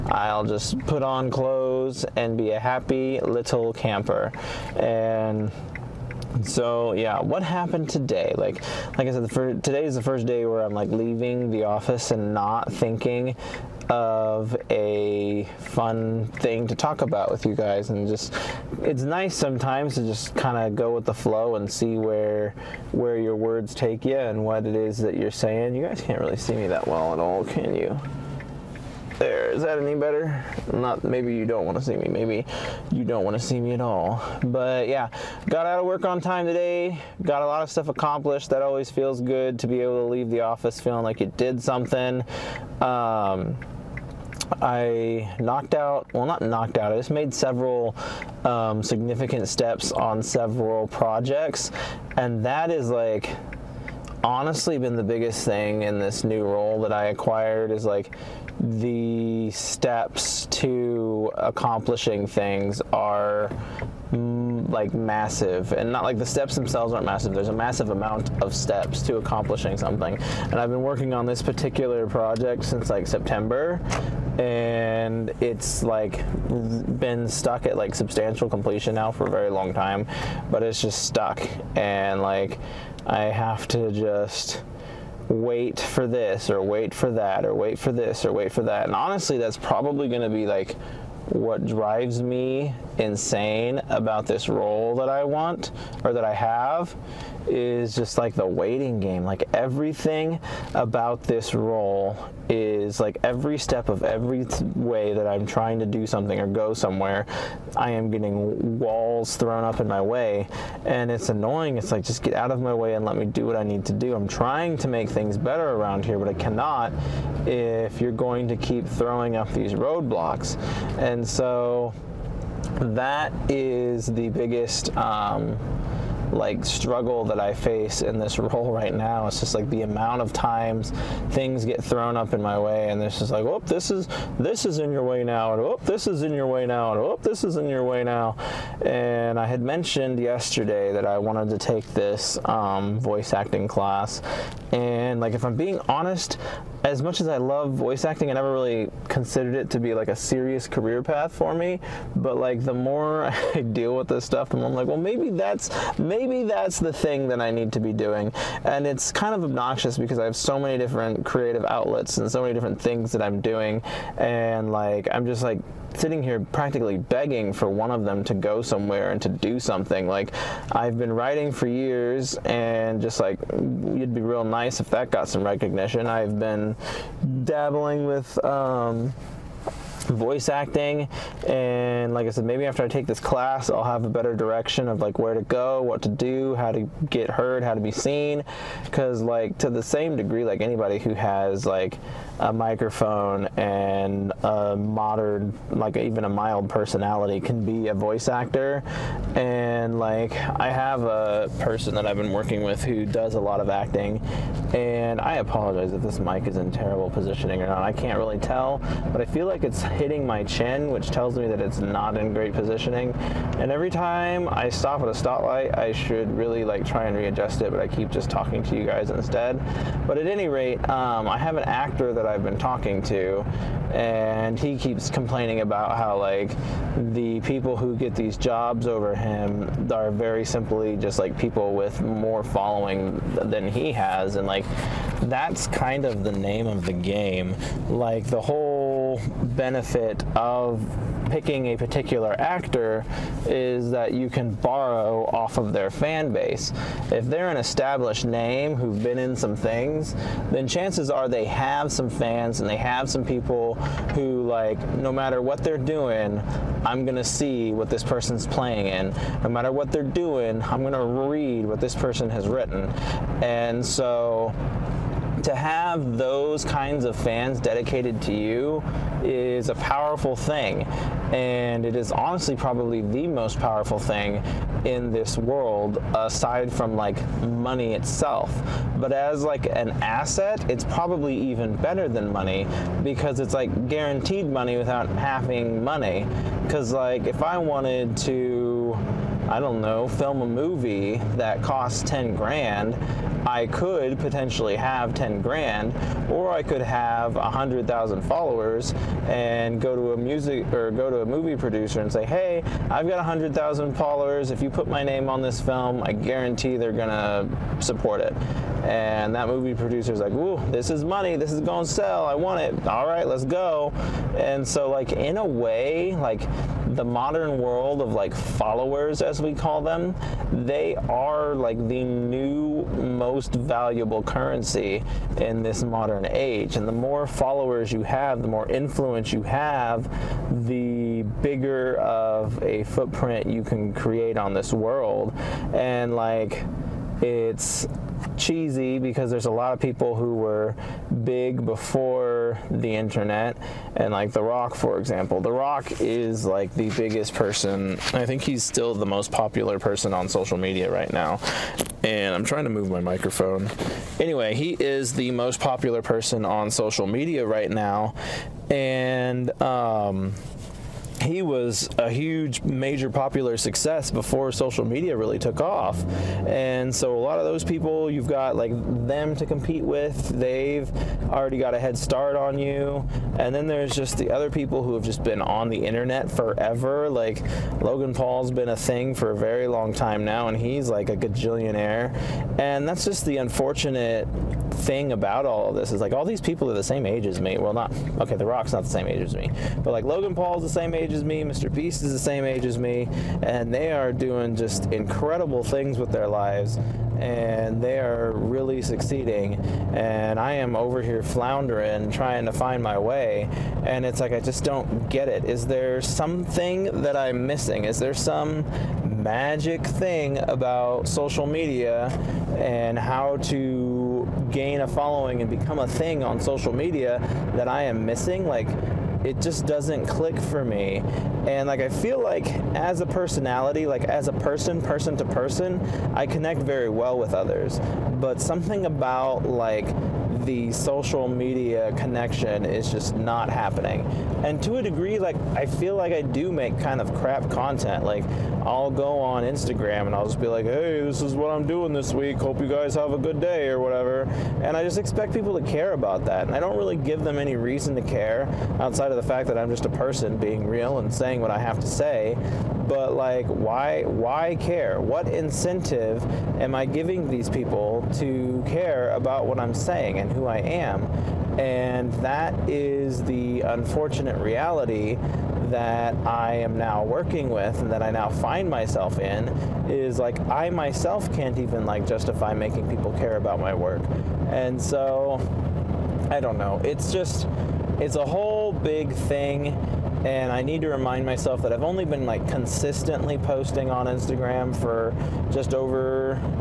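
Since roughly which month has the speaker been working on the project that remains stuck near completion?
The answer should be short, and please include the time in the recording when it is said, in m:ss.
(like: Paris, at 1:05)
September, at 1:13.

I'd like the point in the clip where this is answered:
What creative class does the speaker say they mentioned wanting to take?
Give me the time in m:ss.
2:22.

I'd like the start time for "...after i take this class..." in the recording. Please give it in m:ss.
3:02.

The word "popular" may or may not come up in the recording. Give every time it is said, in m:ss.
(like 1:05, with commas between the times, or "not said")
5:49, 5:55, 6:03.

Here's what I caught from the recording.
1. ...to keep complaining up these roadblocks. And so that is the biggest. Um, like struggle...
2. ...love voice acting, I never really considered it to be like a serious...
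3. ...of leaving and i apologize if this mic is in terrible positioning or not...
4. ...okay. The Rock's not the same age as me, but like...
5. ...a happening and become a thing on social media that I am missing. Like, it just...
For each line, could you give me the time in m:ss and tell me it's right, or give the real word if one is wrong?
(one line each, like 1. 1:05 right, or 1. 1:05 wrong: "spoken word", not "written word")
1. 1:58 wrong: "throwing", not "complaining"
2. 2:27 right
3. 3:23 wrong: "acting", not "leaving"
4. 6:28 right
5. 6:54 wrong: "following", not "happening".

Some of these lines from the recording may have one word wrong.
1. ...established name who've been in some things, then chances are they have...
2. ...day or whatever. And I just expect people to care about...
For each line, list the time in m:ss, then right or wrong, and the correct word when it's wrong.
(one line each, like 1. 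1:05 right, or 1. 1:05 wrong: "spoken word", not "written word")
1. 4:07 right
2. 7:23 right.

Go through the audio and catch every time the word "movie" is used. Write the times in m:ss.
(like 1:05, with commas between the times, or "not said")
4:50, 5:01, 5:09.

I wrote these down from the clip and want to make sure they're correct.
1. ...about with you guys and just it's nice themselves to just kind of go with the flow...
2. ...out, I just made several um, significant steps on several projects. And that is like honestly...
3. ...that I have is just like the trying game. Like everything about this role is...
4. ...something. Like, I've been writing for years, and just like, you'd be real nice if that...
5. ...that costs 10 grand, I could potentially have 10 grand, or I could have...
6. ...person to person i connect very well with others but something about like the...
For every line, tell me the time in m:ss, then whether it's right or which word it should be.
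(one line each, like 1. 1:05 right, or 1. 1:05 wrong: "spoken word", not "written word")
1. 0:17 wrong: "sometimes", not "themselves"
2. 0:46 right
3. 1:36 wrong: "waiting", not "trying"
4. 2:49 right
5. 4:51 right
6. 7:04 right.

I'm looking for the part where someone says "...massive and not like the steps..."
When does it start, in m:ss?
1:04.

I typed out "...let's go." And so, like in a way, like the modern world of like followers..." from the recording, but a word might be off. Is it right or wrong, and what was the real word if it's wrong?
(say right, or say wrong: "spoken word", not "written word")
right.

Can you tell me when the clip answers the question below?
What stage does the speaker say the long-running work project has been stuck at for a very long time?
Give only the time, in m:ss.
1:17.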